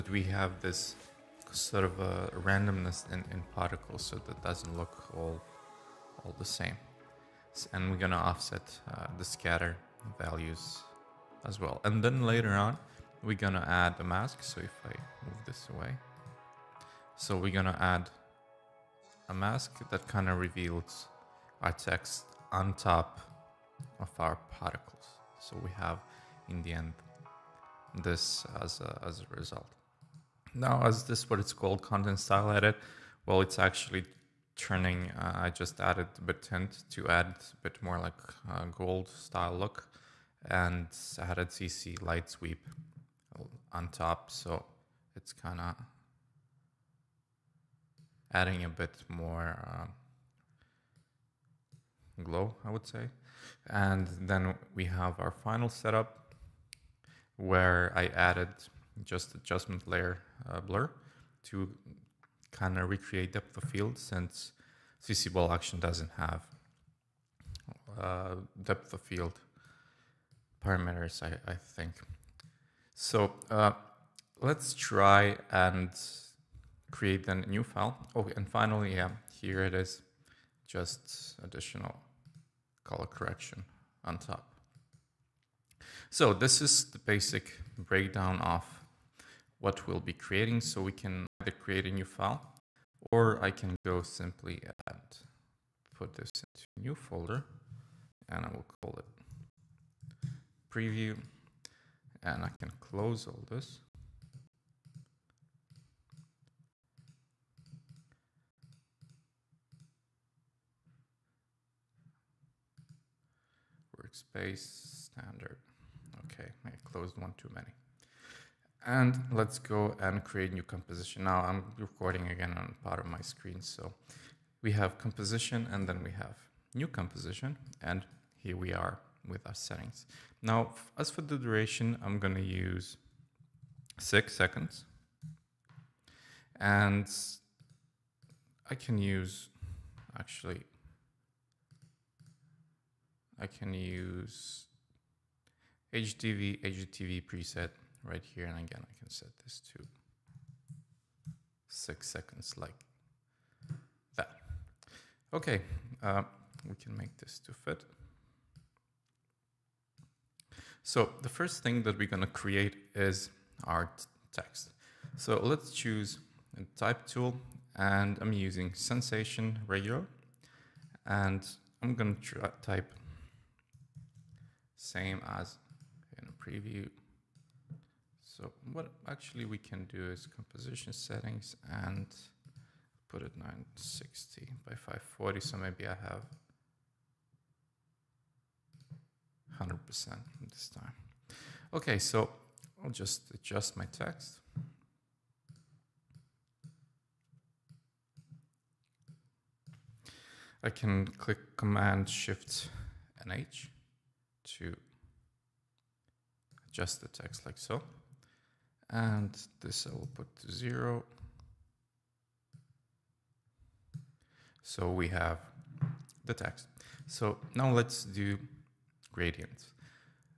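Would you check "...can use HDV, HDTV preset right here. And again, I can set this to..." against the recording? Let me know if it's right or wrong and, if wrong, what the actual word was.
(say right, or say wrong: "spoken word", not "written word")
right.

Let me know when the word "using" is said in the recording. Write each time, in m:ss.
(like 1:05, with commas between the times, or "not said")
2:48.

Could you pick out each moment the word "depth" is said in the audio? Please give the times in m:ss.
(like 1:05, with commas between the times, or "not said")
1:03, 1:08.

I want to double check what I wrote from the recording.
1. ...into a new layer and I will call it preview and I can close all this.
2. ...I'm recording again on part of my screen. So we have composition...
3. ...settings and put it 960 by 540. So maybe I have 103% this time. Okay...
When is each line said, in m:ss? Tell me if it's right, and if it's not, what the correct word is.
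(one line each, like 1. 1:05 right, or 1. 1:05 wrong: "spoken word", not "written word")
1. 1:36 wrong: "folder", not "layer"
2. 2:01 right
3. 3:00 wrong: "100", not "103".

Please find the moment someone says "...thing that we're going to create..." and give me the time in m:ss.
2:41.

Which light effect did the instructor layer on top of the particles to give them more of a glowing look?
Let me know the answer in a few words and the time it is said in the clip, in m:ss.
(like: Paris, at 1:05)
CC Light Sweep, at 0:41.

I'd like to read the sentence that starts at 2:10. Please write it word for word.
Now, as for the duration, I'm going to use six seconds.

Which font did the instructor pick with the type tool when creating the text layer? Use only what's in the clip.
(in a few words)
Sensation Regular.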